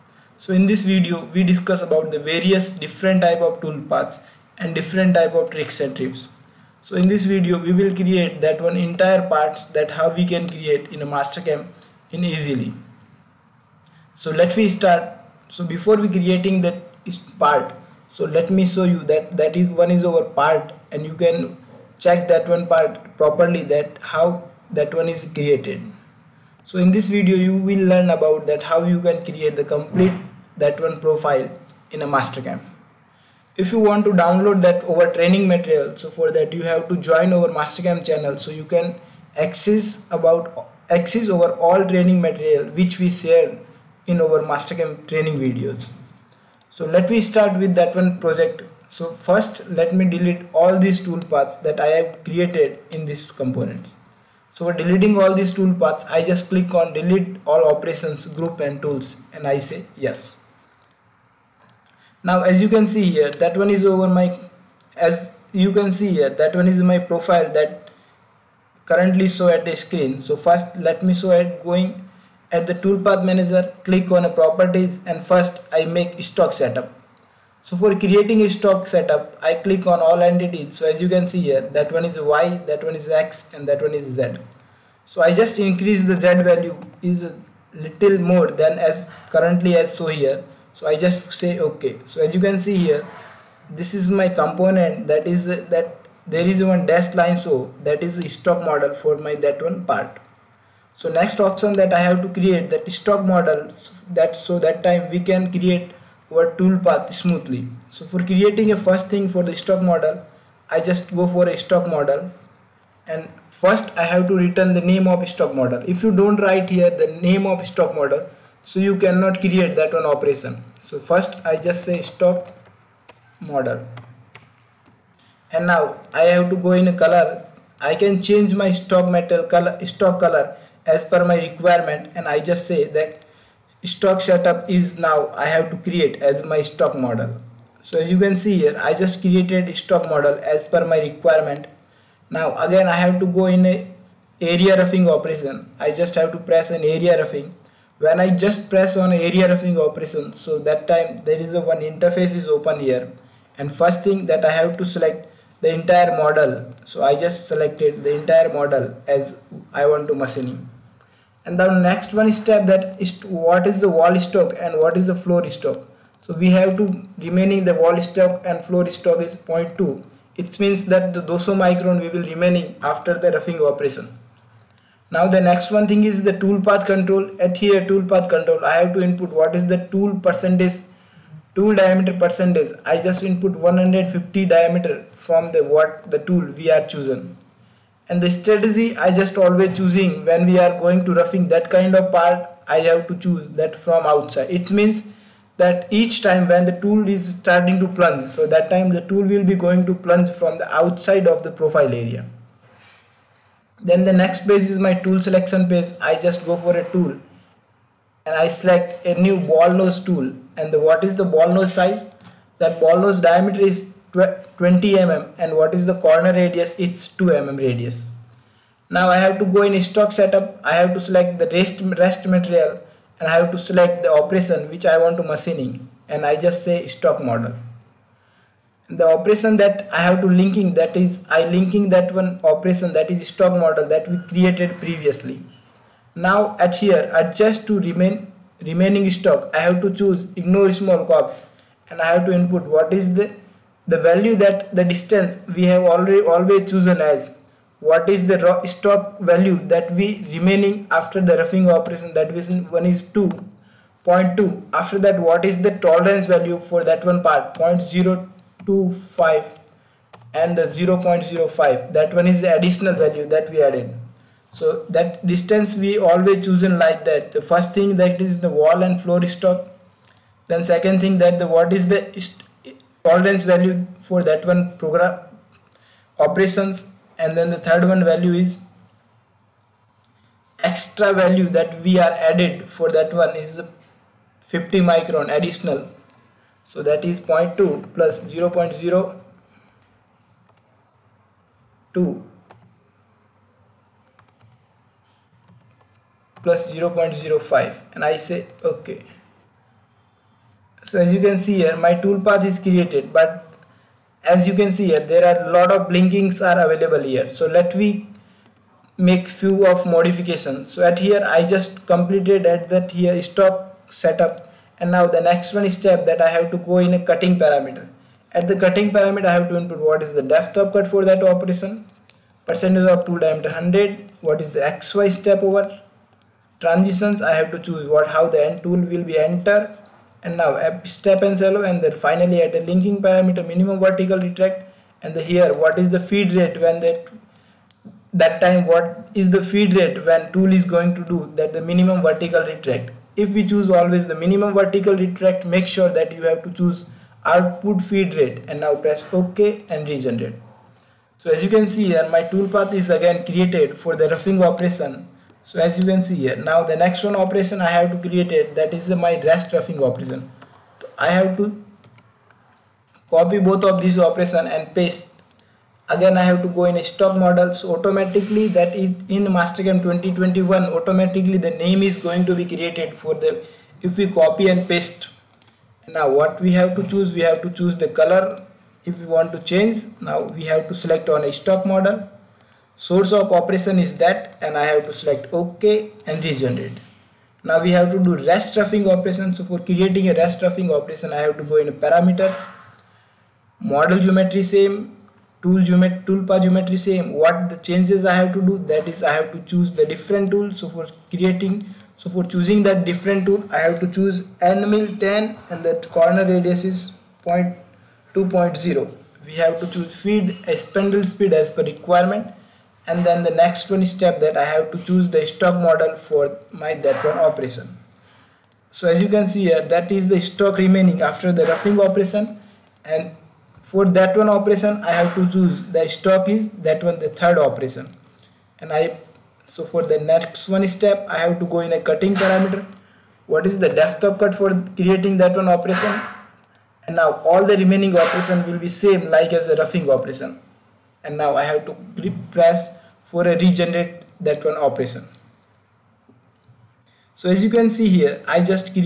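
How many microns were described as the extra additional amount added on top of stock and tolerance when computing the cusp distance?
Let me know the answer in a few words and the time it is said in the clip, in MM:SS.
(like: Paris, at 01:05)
50, at 04:44.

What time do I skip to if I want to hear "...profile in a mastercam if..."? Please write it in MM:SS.
00:31.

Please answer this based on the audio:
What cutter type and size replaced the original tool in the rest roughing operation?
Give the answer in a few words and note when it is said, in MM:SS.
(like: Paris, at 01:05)
end mill 10, at 06:44.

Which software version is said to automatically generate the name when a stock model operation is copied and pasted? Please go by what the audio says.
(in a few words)
Mastercam 2021.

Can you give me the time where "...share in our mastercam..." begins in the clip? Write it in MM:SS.
00:43.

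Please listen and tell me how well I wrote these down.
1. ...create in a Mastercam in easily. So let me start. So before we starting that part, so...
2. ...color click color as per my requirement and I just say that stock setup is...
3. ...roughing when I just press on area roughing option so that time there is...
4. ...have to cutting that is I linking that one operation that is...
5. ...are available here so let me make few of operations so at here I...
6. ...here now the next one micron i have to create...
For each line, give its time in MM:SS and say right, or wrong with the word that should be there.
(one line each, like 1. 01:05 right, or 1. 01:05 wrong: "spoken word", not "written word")
1. 00:10 wrong: "creating", not "starting"
2. 02:09 wrong: "stock", not "click"
3. 02:27 wrong: "operation", not "option"
4. 03:50 wrong: "linking", not "cutting"
5. 05:06 wrong: "modifications", not "operations"
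6. 05:56 wrong: "operation", not "micron".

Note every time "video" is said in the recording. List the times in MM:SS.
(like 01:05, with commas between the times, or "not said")
00:00, 00:07, 00:27, 00:45.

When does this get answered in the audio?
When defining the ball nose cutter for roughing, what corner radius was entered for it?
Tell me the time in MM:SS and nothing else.
03:37.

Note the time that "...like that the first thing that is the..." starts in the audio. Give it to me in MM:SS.
04:26.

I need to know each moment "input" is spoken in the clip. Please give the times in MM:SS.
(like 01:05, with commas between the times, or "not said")
02:59, 03:03, 04:02, 05:19.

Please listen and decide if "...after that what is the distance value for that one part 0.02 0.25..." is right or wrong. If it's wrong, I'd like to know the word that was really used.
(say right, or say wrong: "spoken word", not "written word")
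wrong: "tolerance", not "distance".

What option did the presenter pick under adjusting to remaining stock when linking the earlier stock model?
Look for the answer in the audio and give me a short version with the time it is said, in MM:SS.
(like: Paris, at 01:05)
ignore small cusps, at 04:00.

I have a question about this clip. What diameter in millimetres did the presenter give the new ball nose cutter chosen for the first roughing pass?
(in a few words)
20 mm.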